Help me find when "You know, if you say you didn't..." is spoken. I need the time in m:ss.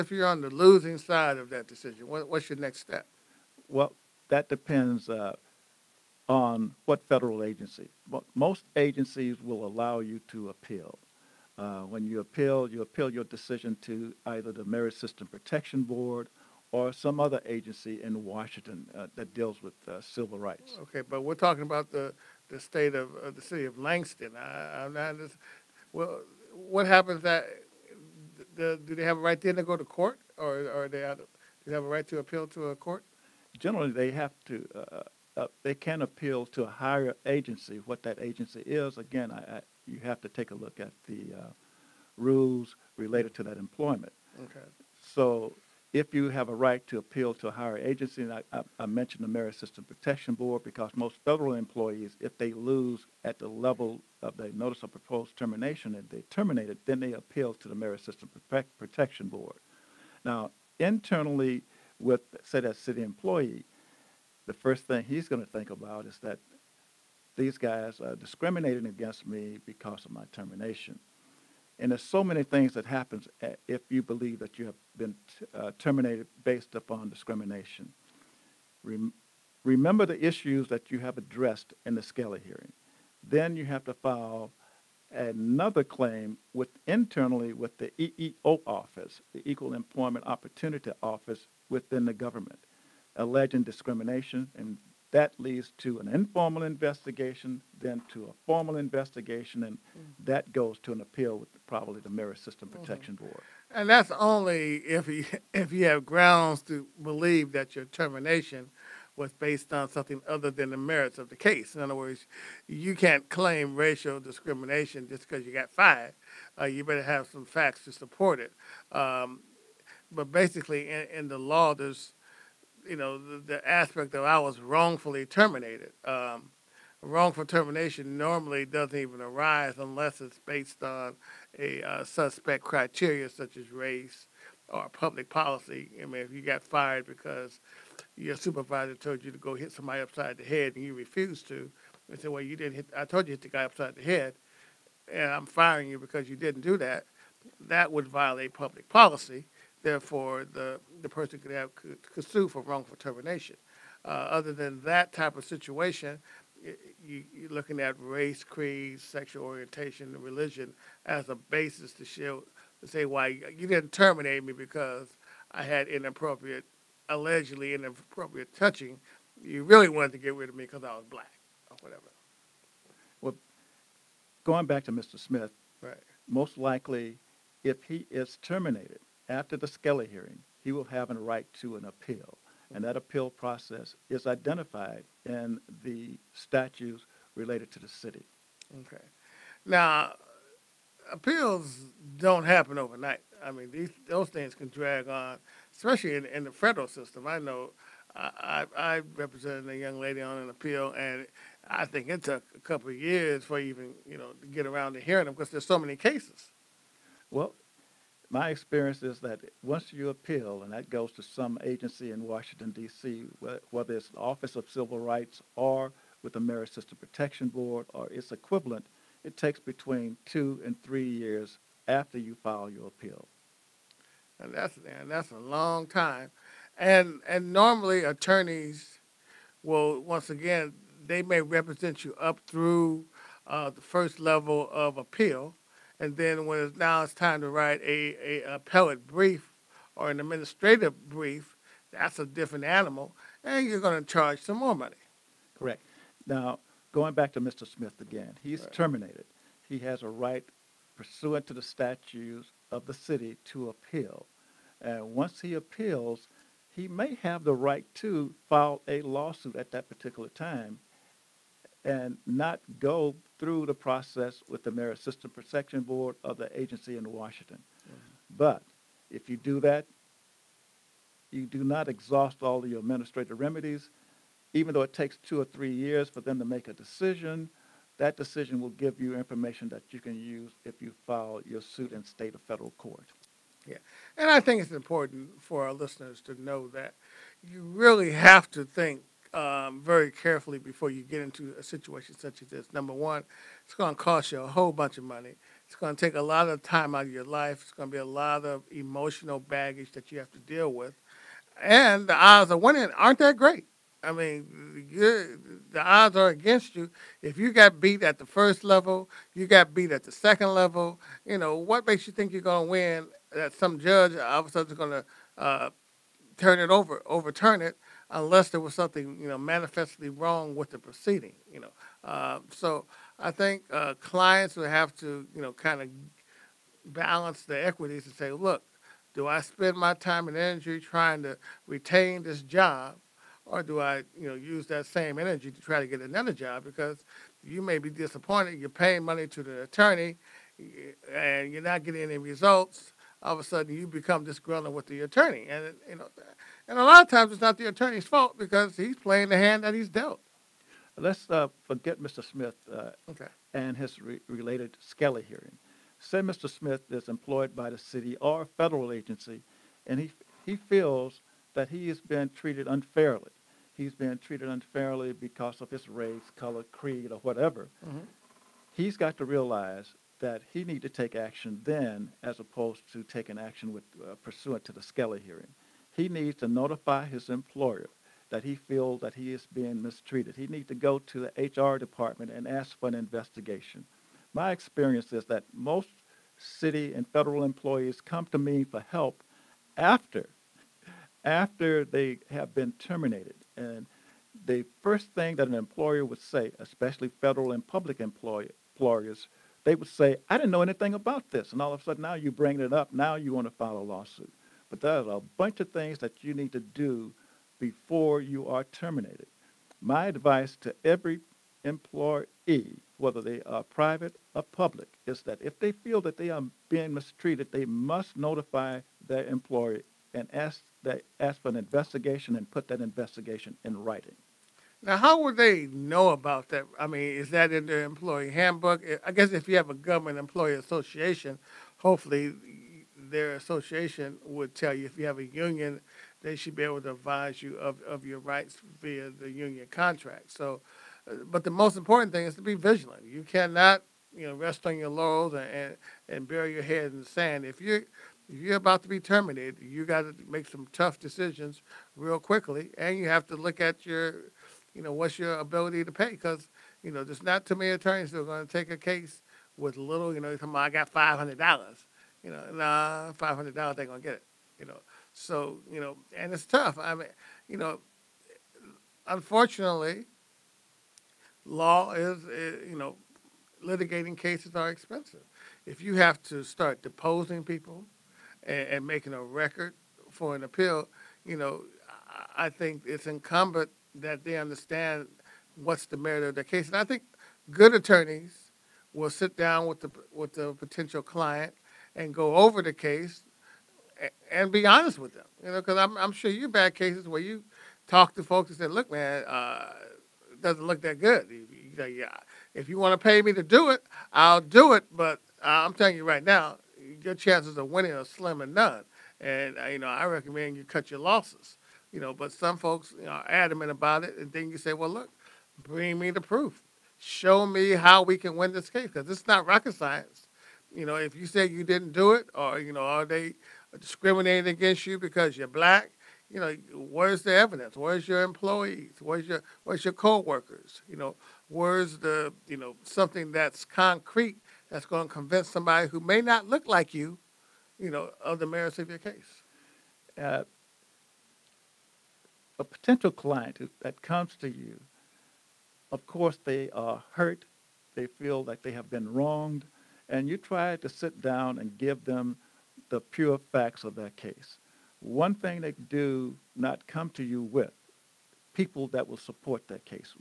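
8:40.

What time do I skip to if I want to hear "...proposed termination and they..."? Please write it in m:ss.
0:54.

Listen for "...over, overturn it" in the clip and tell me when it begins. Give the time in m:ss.
5:16.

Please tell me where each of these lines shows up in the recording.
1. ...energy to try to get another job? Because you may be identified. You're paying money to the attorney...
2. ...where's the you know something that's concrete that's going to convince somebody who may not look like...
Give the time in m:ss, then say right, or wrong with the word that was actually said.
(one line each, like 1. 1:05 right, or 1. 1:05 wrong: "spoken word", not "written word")
1. 5:35 wrong: "disappointed", not "identified"
2. 8:51 right.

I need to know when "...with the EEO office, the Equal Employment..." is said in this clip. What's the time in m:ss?
1:27.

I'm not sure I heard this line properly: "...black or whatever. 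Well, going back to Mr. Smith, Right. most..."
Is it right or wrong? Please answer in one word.
right.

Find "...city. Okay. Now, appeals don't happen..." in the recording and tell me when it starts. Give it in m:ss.
3:07.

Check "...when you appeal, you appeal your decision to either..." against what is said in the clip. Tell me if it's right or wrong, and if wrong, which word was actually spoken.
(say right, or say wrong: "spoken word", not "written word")
right.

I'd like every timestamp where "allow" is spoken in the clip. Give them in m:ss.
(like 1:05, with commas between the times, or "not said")
0:09.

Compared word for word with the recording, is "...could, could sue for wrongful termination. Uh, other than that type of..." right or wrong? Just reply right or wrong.
right.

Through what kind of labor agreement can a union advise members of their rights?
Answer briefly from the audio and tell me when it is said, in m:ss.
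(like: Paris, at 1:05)
union contract, at 7:19.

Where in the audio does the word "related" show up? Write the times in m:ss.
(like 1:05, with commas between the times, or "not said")
0:42, 3:07, 5:54.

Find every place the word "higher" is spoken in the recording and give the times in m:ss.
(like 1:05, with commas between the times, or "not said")
0:36, 0:47.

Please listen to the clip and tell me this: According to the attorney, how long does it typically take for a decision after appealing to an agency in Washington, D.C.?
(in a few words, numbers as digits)
2 to 3 years.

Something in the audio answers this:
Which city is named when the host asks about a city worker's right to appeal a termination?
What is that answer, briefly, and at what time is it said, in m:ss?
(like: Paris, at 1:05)
Langston, at 0:23.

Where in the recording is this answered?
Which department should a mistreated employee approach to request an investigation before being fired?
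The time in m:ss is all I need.
6:21.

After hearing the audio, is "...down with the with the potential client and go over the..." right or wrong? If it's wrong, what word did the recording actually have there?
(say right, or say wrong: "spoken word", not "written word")
right.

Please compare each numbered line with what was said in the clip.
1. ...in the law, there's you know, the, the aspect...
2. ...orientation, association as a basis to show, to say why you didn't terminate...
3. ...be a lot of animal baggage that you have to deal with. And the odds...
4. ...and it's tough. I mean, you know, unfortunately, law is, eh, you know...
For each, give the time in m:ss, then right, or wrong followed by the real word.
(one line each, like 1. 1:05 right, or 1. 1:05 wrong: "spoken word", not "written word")
1. 2:01 right
2. 2:39 wrong: "religion", not "association"
3. 4:57 wrong: "emotional", not "animal"
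4. 7:46 right.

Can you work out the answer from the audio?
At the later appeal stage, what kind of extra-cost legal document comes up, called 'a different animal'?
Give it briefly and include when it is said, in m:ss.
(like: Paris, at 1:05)
administrative brief, at 4:00.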